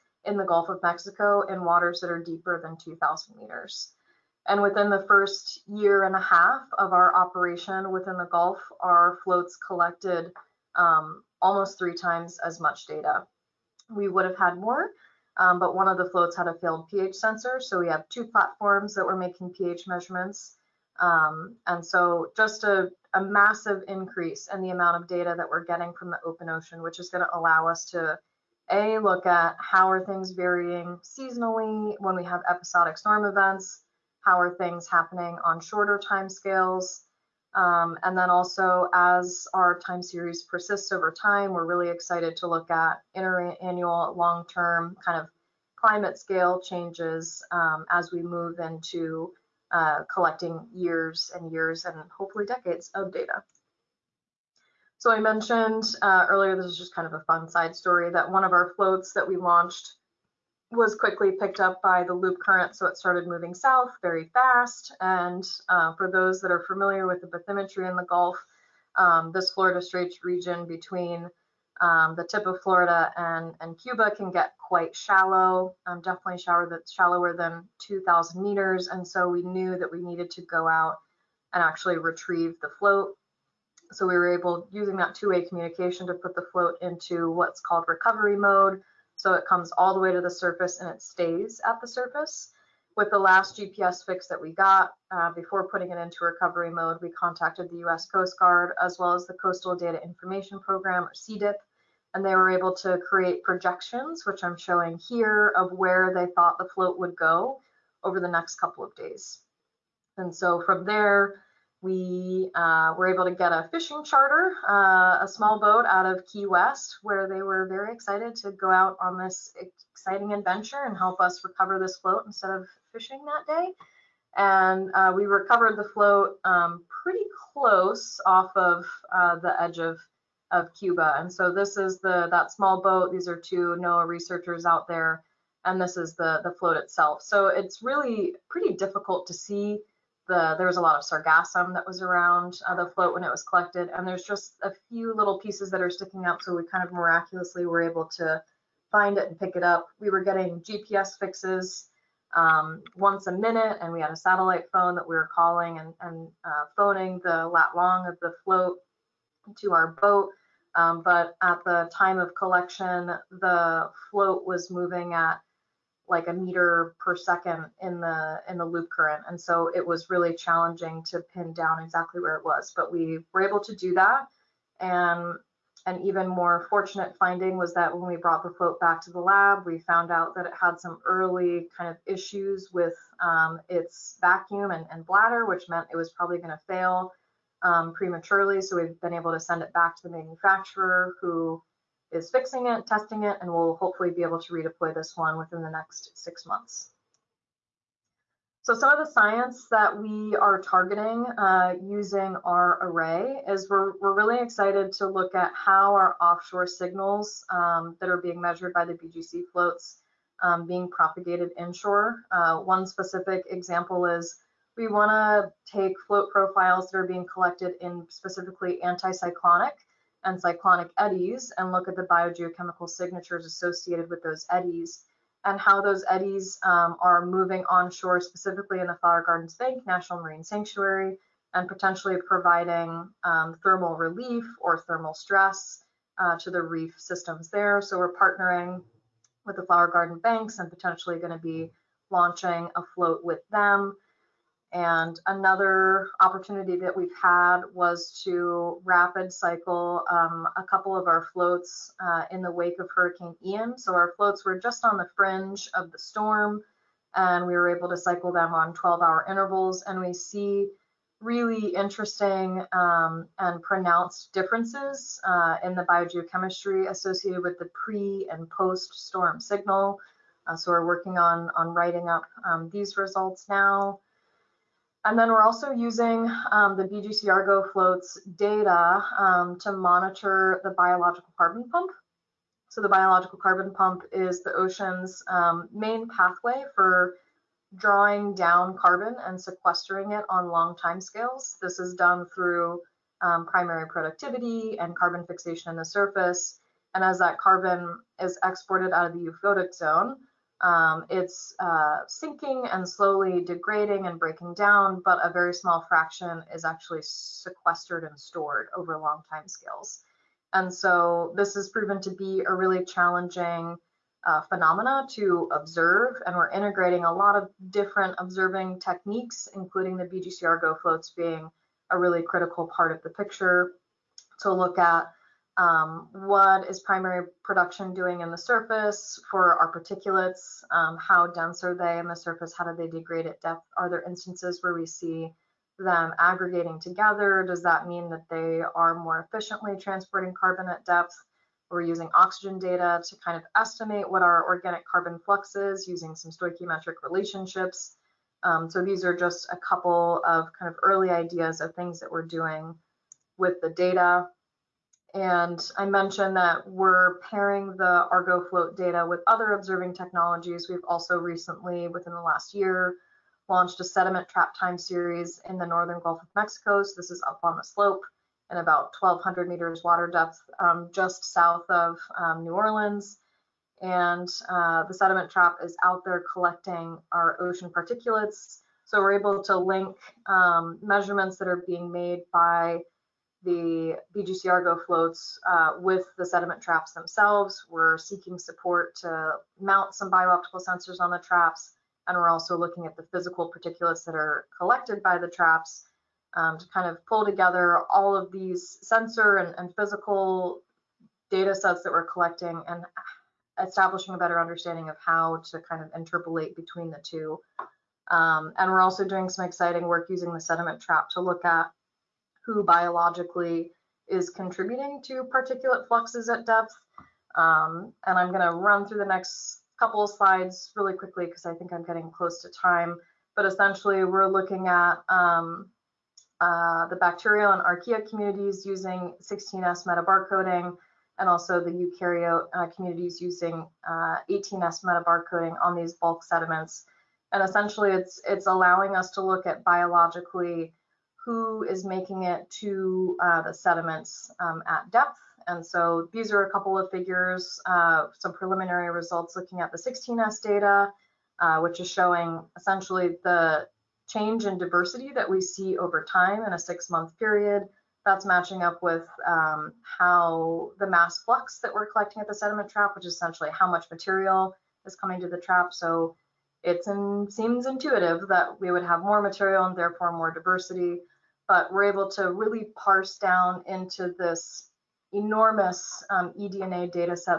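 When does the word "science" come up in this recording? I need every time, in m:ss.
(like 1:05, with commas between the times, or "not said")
3:19.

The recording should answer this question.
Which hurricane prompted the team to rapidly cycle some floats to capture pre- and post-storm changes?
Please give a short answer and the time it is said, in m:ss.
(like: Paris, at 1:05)
Hurricane Ian, at 4:12.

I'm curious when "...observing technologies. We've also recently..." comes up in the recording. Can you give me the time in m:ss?
5:59.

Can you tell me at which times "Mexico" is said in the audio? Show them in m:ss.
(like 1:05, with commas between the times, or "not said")
0:00, 6:06.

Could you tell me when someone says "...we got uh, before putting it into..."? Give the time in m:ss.
1:34.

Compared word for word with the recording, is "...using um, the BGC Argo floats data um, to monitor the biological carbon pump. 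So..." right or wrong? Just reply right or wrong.
right.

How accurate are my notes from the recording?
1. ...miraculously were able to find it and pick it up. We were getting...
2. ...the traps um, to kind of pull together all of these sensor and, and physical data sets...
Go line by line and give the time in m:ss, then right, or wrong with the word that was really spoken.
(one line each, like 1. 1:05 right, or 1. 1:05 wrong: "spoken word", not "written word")
1. 2:26 right
2. 6:35 right.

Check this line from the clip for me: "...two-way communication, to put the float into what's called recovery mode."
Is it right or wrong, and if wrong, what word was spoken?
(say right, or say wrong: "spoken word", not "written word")
right.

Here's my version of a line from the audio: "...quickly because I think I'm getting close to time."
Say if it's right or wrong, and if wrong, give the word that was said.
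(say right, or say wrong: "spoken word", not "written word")
right.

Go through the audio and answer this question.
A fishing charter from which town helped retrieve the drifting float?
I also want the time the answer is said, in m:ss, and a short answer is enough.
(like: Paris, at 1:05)
Key West, at 1:56.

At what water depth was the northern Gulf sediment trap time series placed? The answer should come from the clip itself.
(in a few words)
1,200 meters.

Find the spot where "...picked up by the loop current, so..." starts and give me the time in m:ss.
1:01.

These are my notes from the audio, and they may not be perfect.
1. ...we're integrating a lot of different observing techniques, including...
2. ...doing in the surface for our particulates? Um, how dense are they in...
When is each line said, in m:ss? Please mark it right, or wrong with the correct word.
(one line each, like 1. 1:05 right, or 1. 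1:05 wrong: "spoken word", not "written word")
1. 5:16 right
2. 5:27 right.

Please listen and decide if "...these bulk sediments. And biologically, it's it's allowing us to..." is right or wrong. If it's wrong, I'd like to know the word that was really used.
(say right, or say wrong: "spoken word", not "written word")
wrong: "essentially", not "biologically".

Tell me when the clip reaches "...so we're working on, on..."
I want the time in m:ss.
4:30.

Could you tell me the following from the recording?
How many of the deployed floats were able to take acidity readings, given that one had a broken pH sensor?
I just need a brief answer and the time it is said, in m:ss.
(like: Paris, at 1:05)
2, at 0:18.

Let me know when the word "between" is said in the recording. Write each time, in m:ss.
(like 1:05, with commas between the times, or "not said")
1:10, 6:46.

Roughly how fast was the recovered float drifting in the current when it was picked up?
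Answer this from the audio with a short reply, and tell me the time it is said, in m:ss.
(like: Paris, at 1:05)
1 meter per second, at 2:46.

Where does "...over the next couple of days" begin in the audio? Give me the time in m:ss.
1:48.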